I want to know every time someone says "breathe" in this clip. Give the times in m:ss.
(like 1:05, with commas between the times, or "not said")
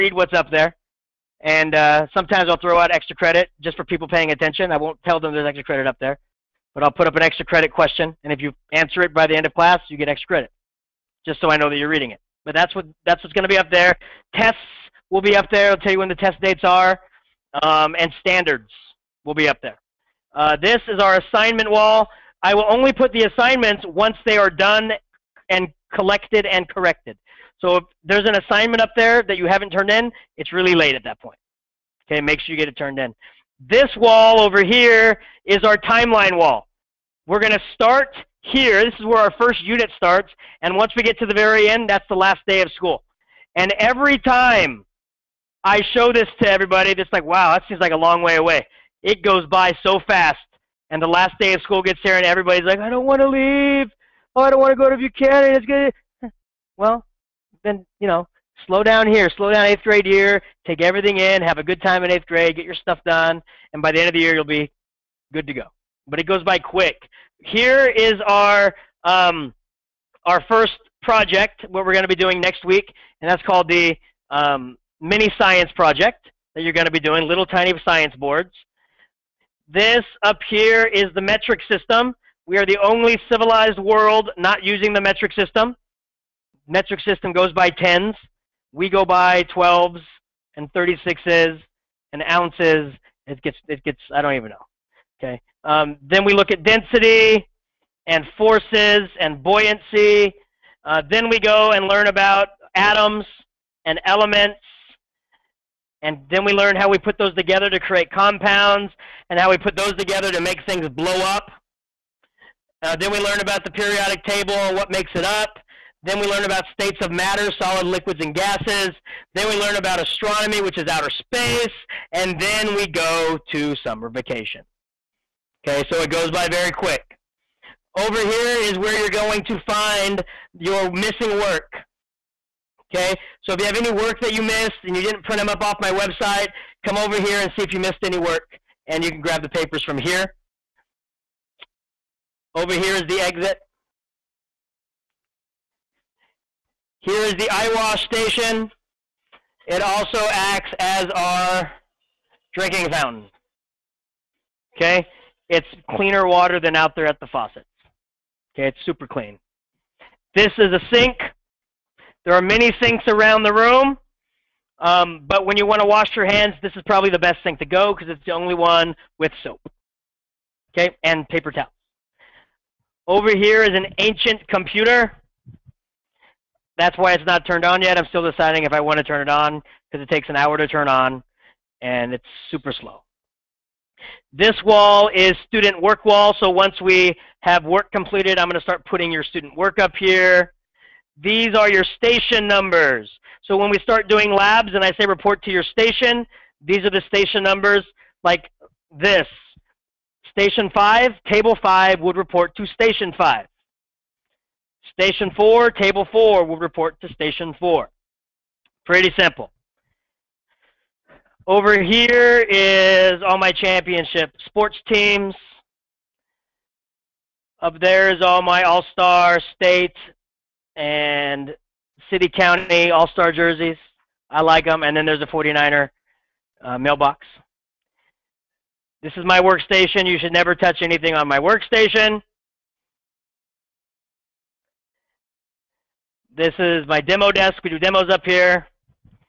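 not said.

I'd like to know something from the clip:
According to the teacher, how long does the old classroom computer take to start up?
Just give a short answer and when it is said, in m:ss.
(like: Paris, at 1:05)
an hour, at 3:00.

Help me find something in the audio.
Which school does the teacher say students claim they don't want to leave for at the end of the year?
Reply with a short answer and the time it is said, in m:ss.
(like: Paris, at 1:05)
Buchanan, at 0:54.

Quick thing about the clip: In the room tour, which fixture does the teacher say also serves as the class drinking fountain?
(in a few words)
eyewash station.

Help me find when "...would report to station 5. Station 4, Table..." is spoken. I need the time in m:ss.
3:21.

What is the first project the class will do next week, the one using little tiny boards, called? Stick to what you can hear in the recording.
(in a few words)
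mini science project.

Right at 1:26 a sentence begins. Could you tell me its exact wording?
Metric system goes by tens we go by 12s and 36s and ounces.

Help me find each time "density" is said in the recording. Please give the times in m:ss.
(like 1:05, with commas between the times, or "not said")
1:36.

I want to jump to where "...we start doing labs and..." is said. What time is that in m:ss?
3:13.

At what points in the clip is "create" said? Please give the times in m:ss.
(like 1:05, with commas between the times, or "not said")
1:47.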